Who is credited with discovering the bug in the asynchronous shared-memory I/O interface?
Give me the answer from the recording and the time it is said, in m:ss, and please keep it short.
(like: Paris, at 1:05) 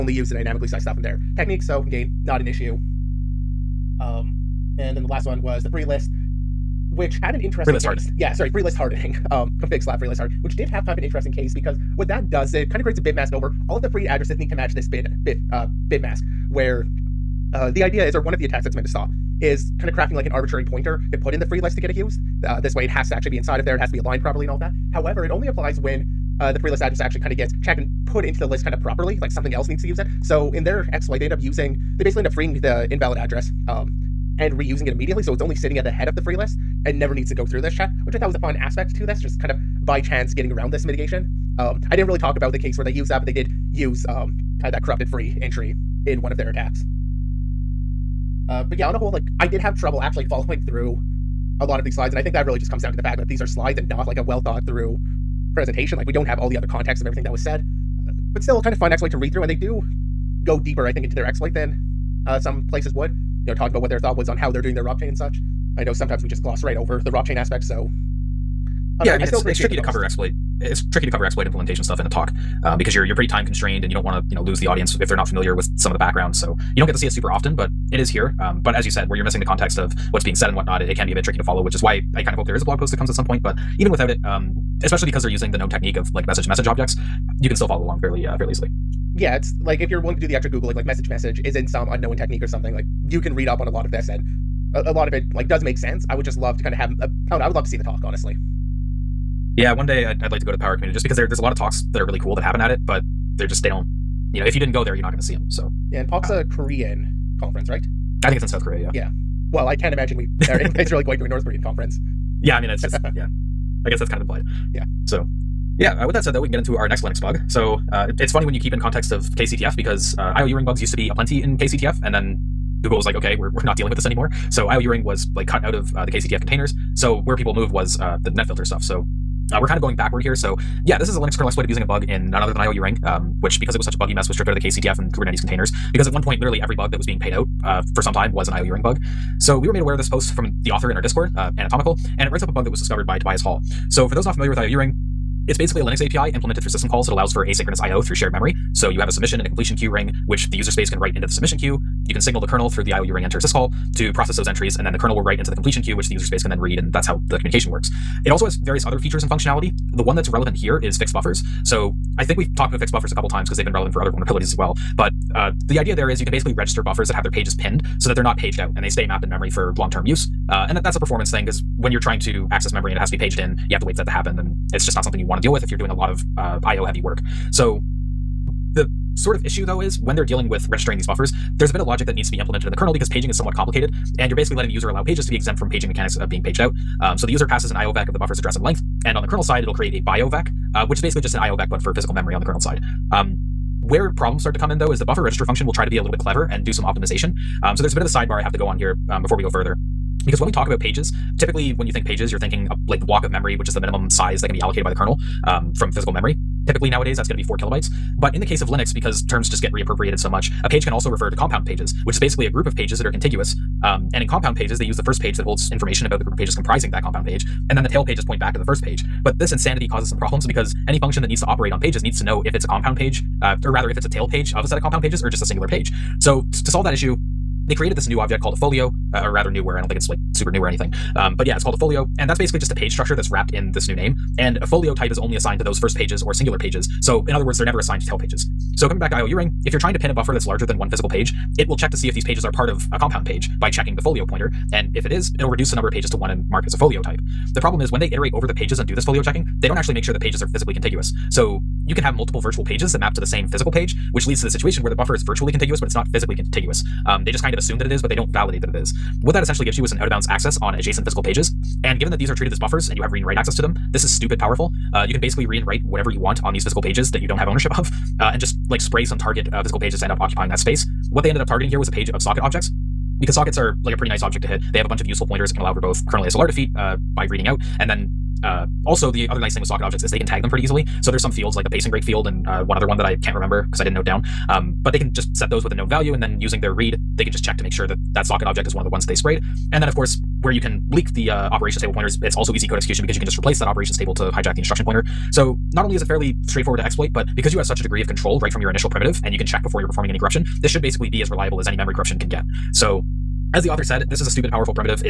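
Tobias Hall, at 2:23.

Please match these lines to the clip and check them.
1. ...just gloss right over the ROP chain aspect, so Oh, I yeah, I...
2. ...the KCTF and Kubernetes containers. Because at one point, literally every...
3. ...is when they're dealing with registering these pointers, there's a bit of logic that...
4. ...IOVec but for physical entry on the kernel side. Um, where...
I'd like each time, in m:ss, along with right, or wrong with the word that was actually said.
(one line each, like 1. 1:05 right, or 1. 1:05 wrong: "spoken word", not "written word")
1. 1:06 right
2. 2:14 right
3. 2:59 wrong: "buffers", not "pointers"
4. 3:11 wrong: "memory", not "entry".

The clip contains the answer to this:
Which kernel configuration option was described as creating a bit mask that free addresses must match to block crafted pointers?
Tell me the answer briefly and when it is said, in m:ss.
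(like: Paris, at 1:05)
config slab free list hard, at 0:09.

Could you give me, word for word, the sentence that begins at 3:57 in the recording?
So in other words, they're never assigned to tail pages.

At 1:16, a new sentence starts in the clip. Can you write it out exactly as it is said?
So you don't get to see it super often, but it is here.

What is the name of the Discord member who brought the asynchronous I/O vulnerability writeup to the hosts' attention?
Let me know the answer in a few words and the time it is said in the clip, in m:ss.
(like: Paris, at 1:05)
Anatomical, at 2:21.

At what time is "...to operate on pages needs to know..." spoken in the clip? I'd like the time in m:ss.
3:41.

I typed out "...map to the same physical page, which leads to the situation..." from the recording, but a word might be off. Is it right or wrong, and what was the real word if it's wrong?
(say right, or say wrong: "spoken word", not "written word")
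right.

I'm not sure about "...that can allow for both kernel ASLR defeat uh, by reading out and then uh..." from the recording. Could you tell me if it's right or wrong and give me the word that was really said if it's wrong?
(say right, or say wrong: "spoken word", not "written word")
right.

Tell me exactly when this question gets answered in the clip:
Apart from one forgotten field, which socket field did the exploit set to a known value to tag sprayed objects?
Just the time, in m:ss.
4:41.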